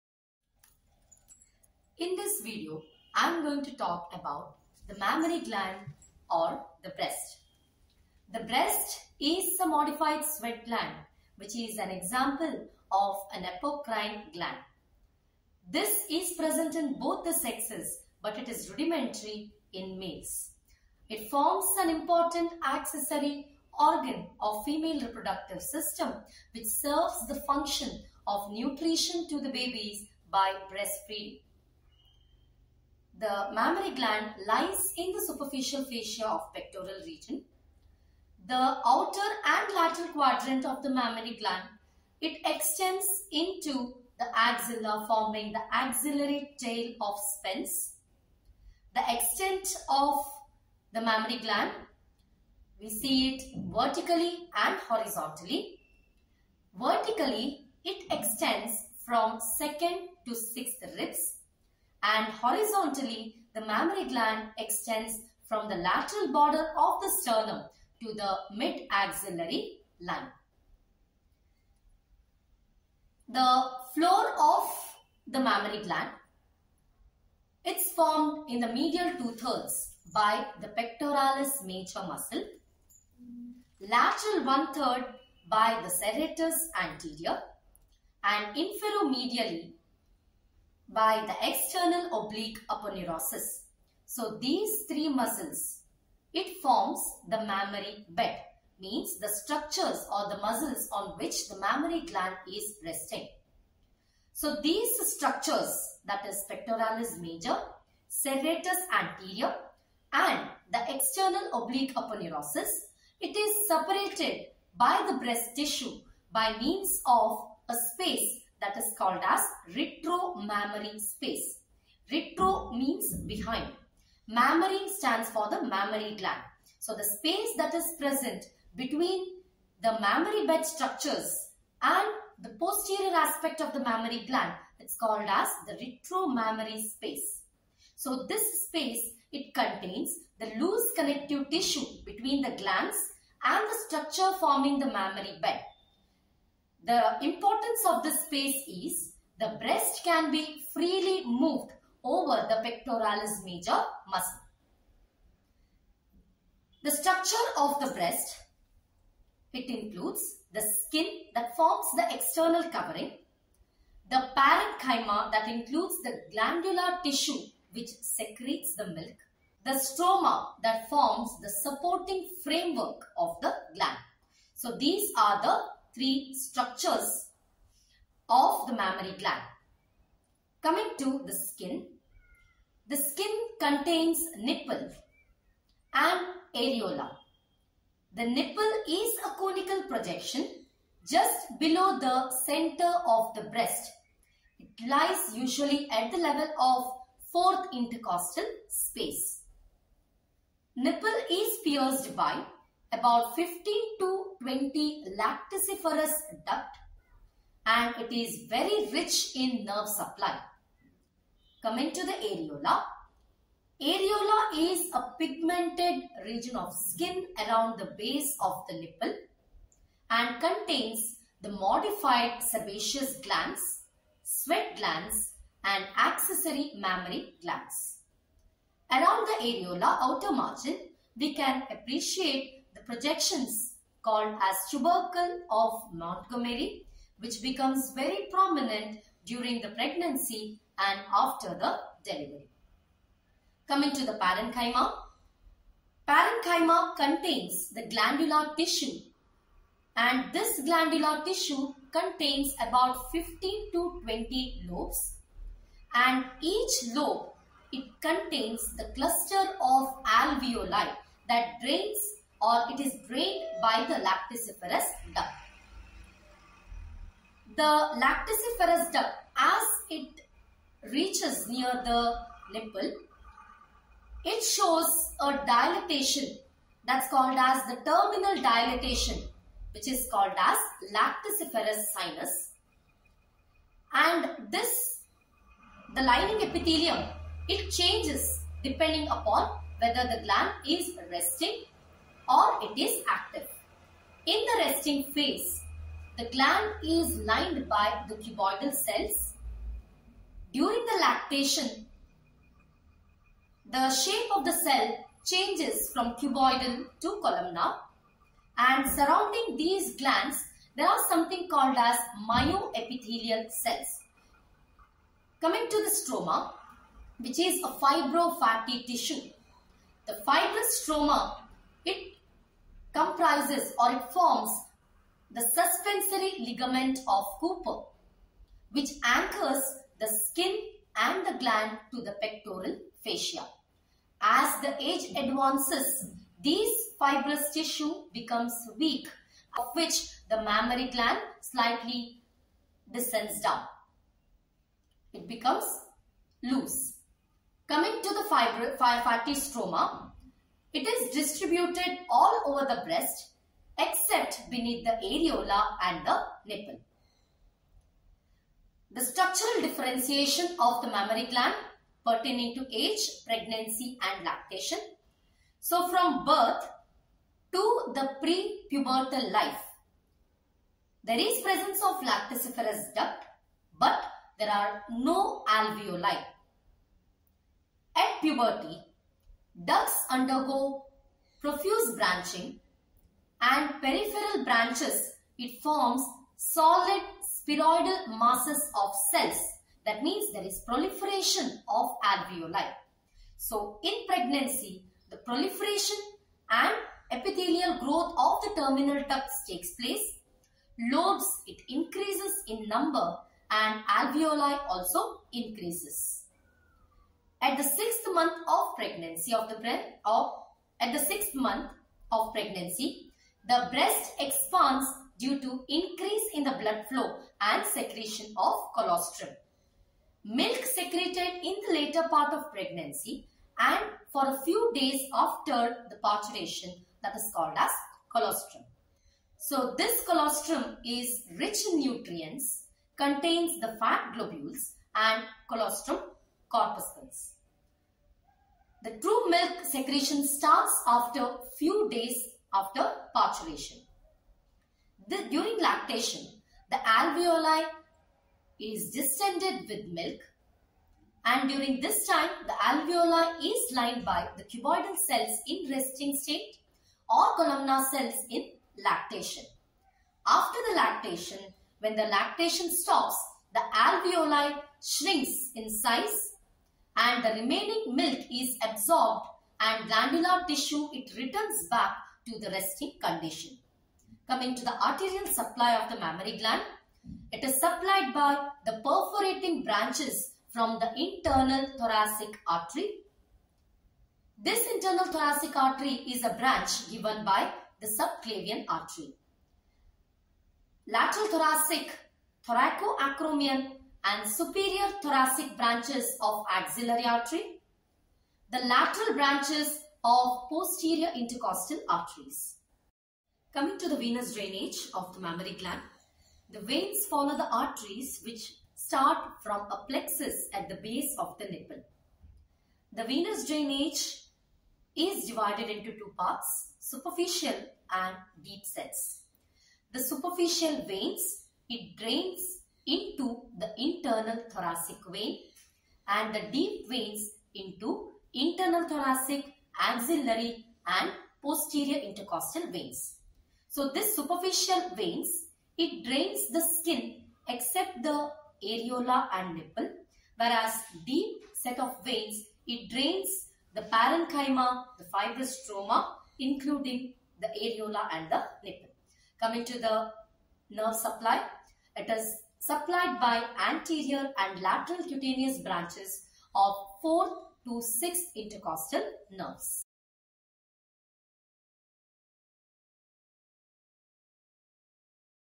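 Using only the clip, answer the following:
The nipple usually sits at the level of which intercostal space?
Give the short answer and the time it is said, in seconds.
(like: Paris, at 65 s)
4th intercostal space, at 197 s.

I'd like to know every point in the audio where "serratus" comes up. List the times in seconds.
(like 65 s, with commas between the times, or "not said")
85 s, 108 s.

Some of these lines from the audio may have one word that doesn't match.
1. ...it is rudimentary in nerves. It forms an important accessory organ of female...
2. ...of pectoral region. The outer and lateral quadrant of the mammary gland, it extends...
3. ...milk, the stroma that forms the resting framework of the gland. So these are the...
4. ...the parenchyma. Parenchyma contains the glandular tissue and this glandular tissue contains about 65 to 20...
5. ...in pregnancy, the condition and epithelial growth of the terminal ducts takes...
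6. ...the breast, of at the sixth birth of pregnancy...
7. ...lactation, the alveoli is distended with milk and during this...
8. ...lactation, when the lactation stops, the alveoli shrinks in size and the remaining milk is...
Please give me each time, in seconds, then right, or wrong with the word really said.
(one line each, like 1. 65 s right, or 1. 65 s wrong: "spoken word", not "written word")
1. 18 s wrong: "males", not "nerves"
2. 36 s right
3. 168 s wrong: "supporting", not "resting"
4. 244 s wrong: "15", not "65"
5. 393 s wrong: "proliferation", not "condition"
6. 409 s wrong: "month", not "birth"
7. 445 s right
8. 460 s right.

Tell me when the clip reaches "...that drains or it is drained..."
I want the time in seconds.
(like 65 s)
261 s.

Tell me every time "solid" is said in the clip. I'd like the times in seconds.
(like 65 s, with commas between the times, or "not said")
386 s.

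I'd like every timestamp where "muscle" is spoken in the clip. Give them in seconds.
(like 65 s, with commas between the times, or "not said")
82 s, 95 s, 100 s, 154 s.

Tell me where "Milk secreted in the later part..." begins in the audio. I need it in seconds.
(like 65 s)
420 s.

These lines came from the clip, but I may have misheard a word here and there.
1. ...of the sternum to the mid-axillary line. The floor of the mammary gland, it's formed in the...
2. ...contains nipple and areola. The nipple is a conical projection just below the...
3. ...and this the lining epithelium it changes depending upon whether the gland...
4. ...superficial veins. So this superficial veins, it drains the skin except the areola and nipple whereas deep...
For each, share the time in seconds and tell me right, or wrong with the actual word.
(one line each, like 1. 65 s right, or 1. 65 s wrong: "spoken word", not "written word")
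1. 66 s right
2. 183 s right
3. 283 s right
4. 532 s wrong: "intercostal", not "superficial".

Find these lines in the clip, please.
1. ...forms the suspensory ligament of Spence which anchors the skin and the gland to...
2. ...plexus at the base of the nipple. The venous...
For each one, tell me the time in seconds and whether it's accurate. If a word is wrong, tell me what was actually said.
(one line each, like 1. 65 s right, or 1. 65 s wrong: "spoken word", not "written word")
1. 324 s wrong: "Cooper", not "Spence"
2. 509 s right.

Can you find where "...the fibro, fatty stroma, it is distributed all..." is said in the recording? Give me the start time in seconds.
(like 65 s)
348 s.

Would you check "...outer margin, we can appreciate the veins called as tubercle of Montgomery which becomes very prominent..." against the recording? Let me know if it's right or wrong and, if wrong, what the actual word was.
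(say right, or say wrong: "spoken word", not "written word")
wrong: "projections", not "veins".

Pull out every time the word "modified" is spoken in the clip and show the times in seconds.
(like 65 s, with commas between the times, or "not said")
9 s, 221 s.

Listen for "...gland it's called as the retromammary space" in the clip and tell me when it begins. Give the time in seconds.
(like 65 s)
134 s.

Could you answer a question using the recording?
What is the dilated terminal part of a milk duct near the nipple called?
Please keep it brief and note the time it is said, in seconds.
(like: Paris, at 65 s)
Lacticiferous sinus, at 280 s.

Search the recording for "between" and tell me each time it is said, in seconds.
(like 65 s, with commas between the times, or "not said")
128 s, 142 s.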